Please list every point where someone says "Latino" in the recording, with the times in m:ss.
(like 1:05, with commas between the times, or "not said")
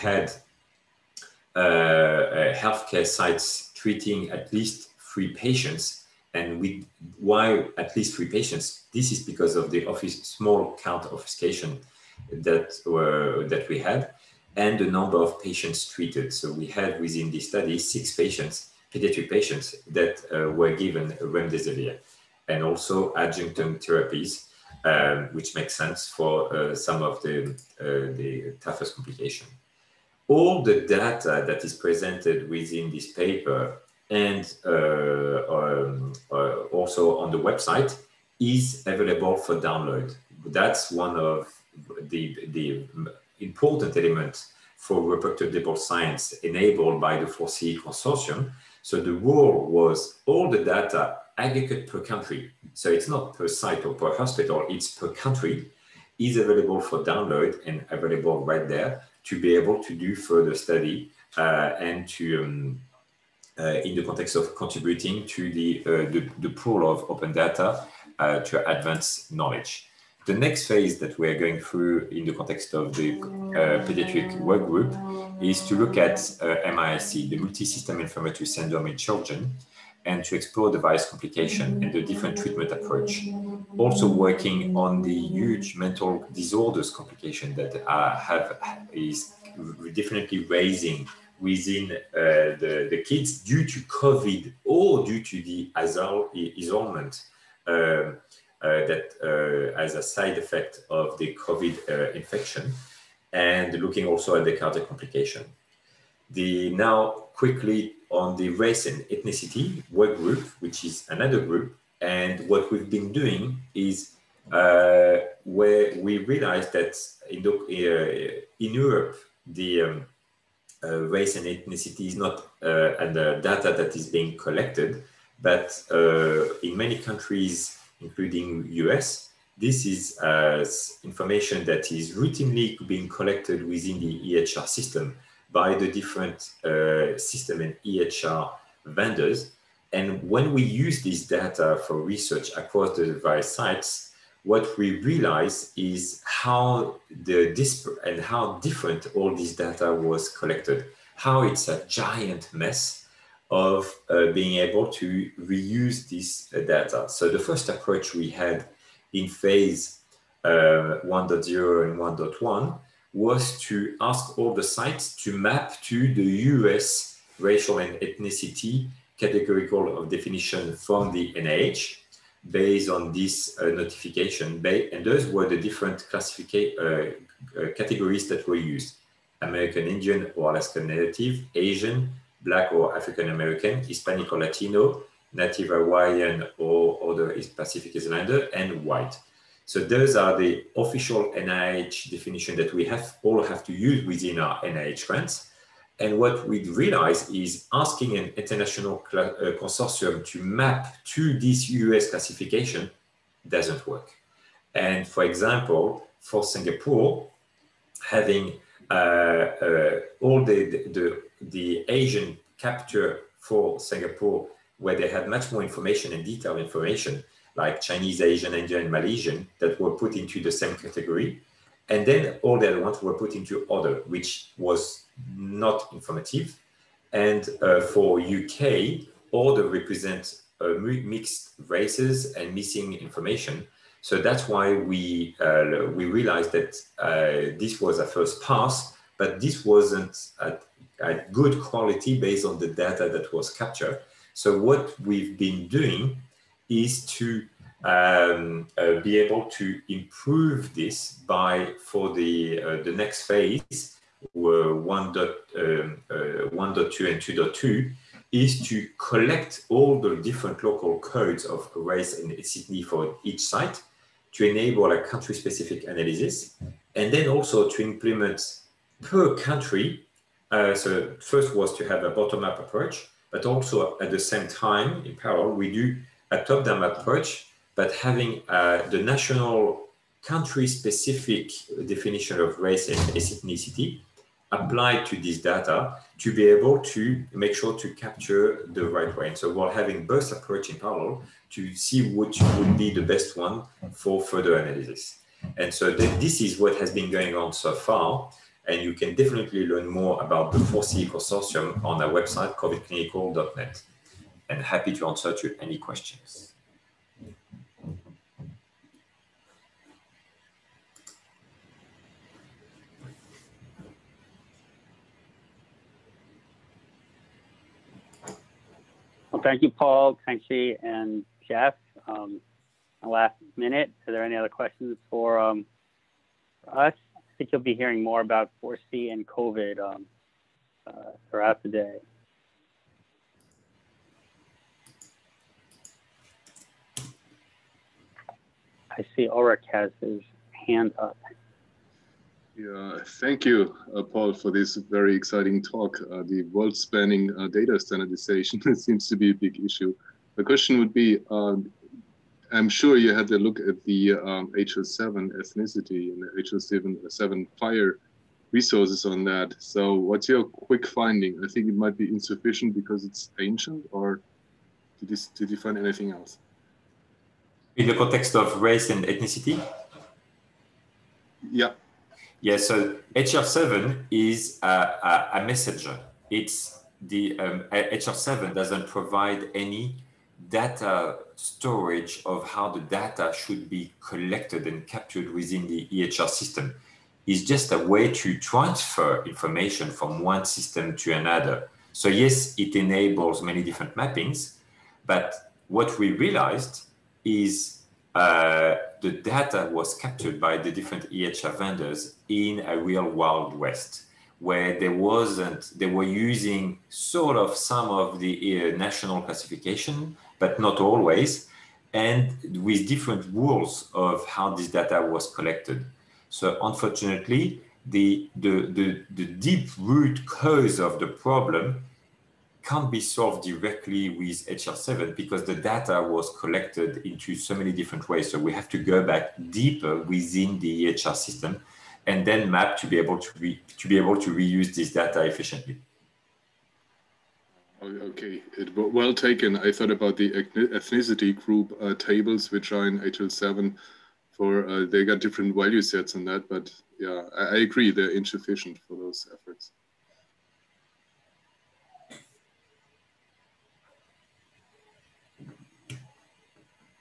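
3:04.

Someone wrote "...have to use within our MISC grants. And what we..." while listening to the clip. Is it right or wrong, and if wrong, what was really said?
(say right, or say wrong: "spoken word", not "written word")
wrong: "NIH", not "MISC".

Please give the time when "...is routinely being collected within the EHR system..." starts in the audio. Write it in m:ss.
2:11.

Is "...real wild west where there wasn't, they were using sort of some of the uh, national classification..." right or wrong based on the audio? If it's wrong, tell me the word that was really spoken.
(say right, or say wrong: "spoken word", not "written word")
right.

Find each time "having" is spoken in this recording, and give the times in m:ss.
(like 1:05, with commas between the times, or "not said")
3:28, 4:37, 4:49.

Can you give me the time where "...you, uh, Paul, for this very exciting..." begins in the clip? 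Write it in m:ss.
5:43.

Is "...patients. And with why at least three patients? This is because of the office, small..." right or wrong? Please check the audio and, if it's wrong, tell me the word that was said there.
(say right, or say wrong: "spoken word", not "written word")
right.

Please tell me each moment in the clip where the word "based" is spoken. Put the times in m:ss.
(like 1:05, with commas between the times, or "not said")
2:52, 4:02.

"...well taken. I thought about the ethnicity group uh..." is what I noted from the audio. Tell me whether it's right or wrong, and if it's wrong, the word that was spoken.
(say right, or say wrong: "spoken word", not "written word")
right.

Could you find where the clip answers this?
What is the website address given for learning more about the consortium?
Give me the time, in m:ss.
5:02.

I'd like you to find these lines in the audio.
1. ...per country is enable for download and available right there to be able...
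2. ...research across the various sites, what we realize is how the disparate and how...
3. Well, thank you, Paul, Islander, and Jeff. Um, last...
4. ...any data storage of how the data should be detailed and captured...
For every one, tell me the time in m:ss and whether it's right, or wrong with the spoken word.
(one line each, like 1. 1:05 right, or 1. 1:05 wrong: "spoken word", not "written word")
1. 0:54 wrong: "available", not "enable"
2. 2:22 right
3. 5:19 wrong: "Kenshi", not "Islander"
4. 6:19 wrong: "collected", not "detailed".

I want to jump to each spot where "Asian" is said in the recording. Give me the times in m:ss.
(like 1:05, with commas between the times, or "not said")
3:01, 3:31, 3:38.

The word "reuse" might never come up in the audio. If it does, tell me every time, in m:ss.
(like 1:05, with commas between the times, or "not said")
2:35, 7:14.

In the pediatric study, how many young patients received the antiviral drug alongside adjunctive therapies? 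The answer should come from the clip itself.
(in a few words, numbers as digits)
6.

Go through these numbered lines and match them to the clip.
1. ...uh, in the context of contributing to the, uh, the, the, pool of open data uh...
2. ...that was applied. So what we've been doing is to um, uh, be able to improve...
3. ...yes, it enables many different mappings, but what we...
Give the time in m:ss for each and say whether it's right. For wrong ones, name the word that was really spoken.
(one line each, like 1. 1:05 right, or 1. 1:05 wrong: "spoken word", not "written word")
1. 1:03 right
2. 4:03 wrong: "captured", not "applied"
3. 6:32 right.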